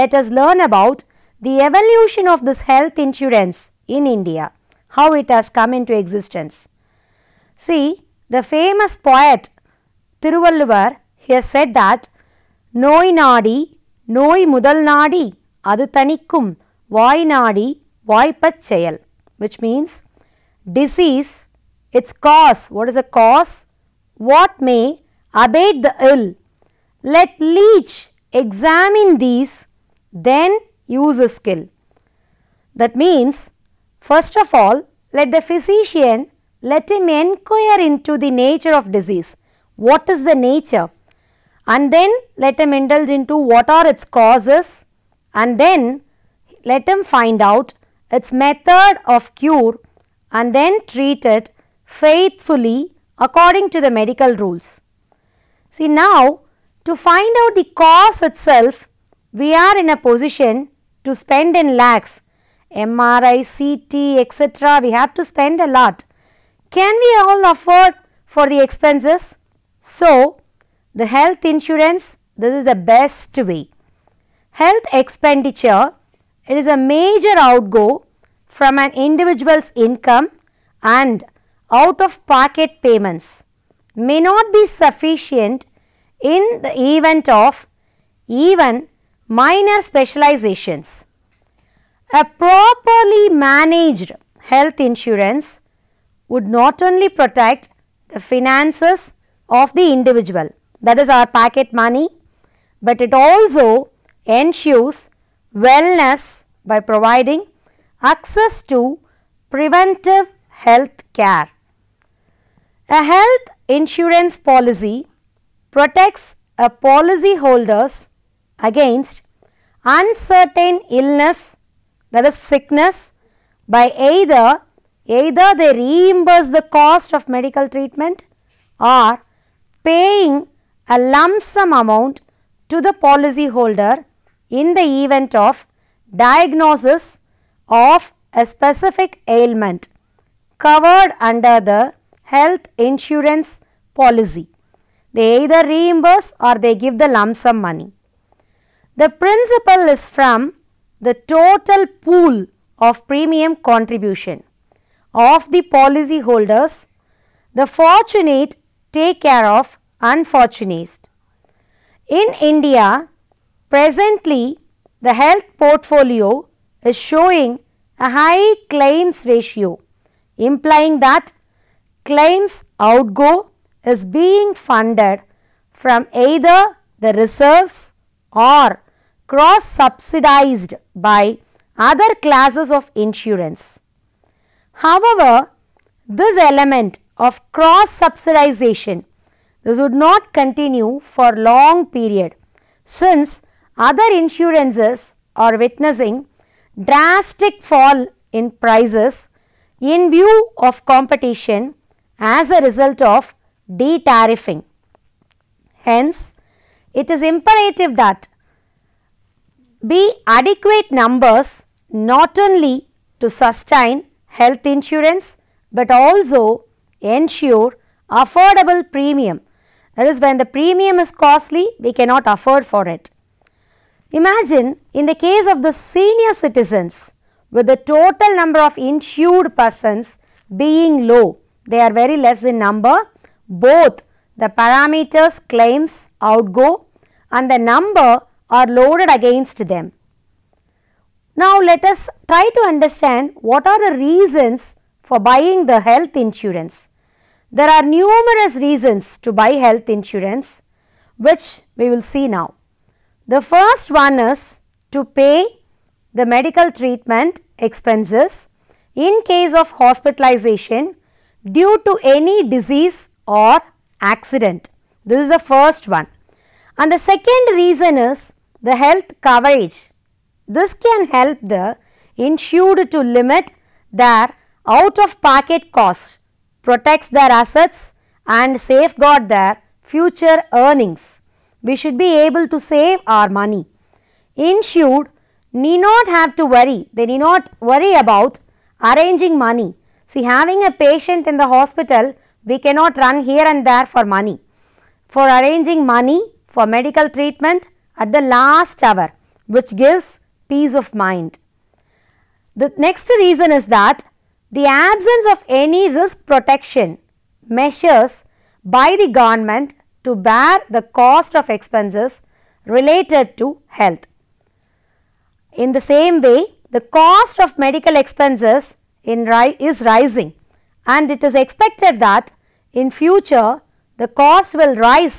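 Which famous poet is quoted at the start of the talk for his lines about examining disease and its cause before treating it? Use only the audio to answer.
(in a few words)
Thiruvalluvar.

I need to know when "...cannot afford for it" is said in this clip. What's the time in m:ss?
3:41.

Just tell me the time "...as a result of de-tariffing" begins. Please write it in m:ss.
3:22.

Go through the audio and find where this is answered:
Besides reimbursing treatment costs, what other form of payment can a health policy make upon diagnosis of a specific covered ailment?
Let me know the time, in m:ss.
2:10.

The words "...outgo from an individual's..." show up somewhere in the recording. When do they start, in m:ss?
1:17.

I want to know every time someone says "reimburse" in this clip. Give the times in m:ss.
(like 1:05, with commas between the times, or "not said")
2:05, 2:25.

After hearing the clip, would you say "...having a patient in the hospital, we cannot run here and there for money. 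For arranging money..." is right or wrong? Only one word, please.
right.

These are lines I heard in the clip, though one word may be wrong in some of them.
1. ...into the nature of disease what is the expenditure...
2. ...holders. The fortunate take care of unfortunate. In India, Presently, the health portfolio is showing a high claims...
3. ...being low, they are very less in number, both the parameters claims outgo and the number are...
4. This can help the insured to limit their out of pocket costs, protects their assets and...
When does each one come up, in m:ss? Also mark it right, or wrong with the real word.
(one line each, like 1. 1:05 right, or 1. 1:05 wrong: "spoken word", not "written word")
1. 0:37 wrong: "nature", not "expenditure"
2. 2:36 right
3. 3:50 right
4. 4:30 right.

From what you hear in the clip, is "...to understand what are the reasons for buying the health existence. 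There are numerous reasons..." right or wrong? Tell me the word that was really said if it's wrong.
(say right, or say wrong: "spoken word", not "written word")
wrong: "insurance", not "existence".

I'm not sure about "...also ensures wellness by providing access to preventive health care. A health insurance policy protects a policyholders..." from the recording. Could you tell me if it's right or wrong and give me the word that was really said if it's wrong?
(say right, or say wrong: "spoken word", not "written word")
right.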